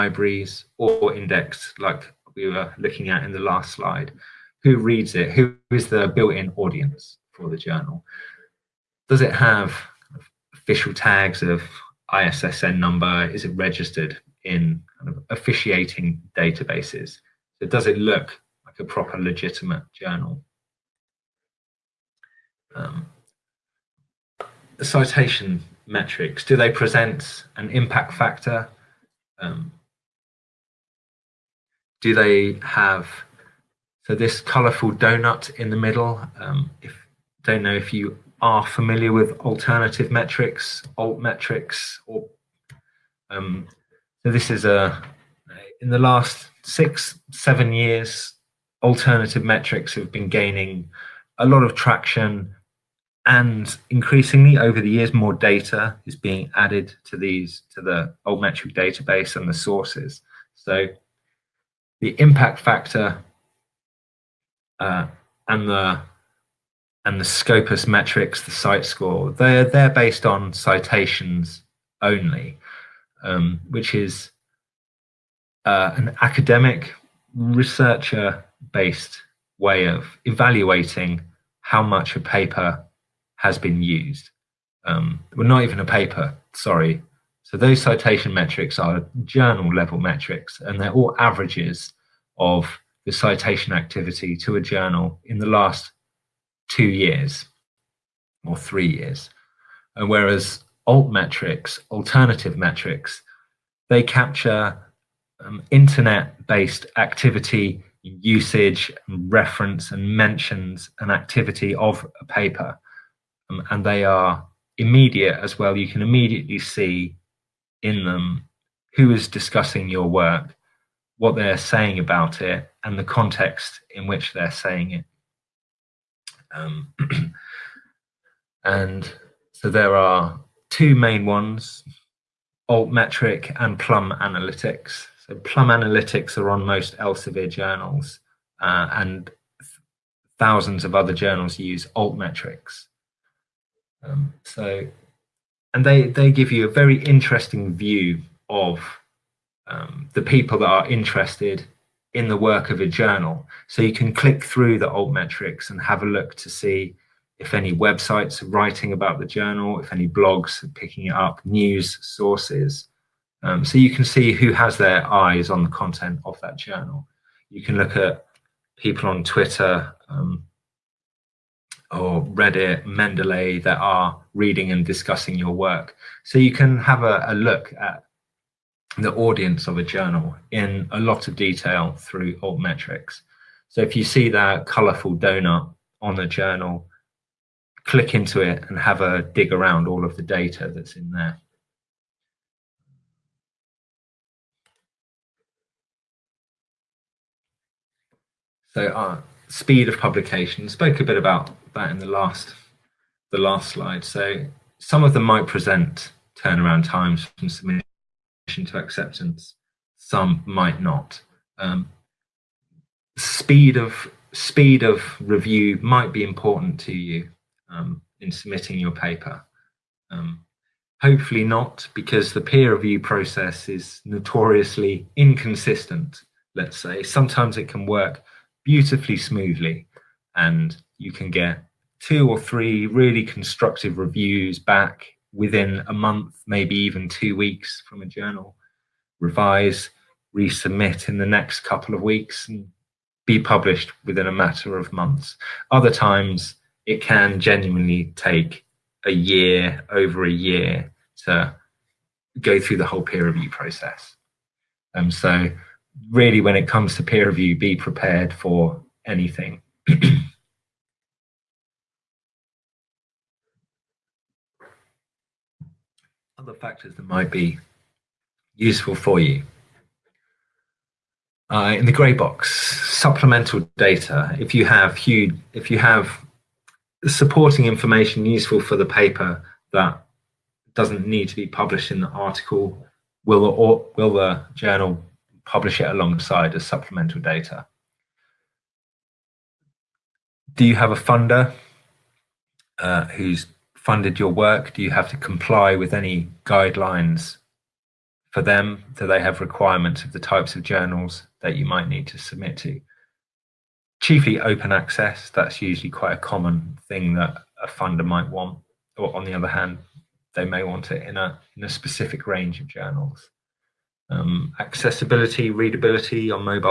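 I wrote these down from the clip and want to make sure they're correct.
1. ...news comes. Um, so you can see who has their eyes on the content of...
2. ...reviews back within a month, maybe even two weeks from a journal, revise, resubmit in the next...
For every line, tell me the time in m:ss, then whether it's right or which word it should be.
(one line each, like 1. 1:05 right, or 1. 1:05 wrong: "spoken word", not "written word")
1. 2:41 wrong: "sources", not "comes"
2. 3:53 right.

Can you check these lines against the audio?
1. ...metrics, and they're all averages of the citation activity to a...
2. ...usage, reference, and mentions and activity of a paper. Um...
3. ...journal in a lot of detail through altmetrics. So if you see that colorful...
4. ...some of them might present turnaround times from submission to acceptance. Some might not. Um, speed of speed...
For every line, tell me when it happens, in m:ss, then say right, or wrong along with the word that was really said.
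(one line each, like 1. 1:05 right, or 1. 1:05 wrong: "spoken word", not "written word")
1. 1:29 right
2. 1:48 right
3. 2:59 right
4. 3:24 right.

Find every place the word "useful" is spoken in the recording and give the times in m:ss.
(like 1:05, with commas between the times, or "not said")
4:28, 4:38.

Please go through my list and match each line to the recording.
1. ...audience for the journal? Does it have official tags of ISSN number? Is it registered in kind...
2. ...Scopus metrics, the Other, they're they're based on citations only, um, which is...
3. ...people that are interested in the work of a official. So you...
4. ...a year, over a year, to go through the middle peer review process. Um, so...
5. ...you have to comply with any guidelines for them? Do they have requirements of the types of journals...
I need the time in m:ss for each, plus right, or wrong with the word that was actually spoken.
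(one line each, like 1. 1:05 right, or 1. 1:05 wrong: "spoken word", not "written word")
1. 0:06 right
2. 1:07 wrong: "CiteScore", not "Other"
3. 2:30 wrong: "journal", not "official"
4. 4:09 wrong: "whole", not "middle"
5. 4:54 right.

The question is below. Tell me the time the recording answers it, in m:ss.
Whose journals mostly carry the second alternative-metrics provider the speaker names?
2:16.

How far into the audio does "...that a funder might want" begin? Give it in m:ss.
5:07.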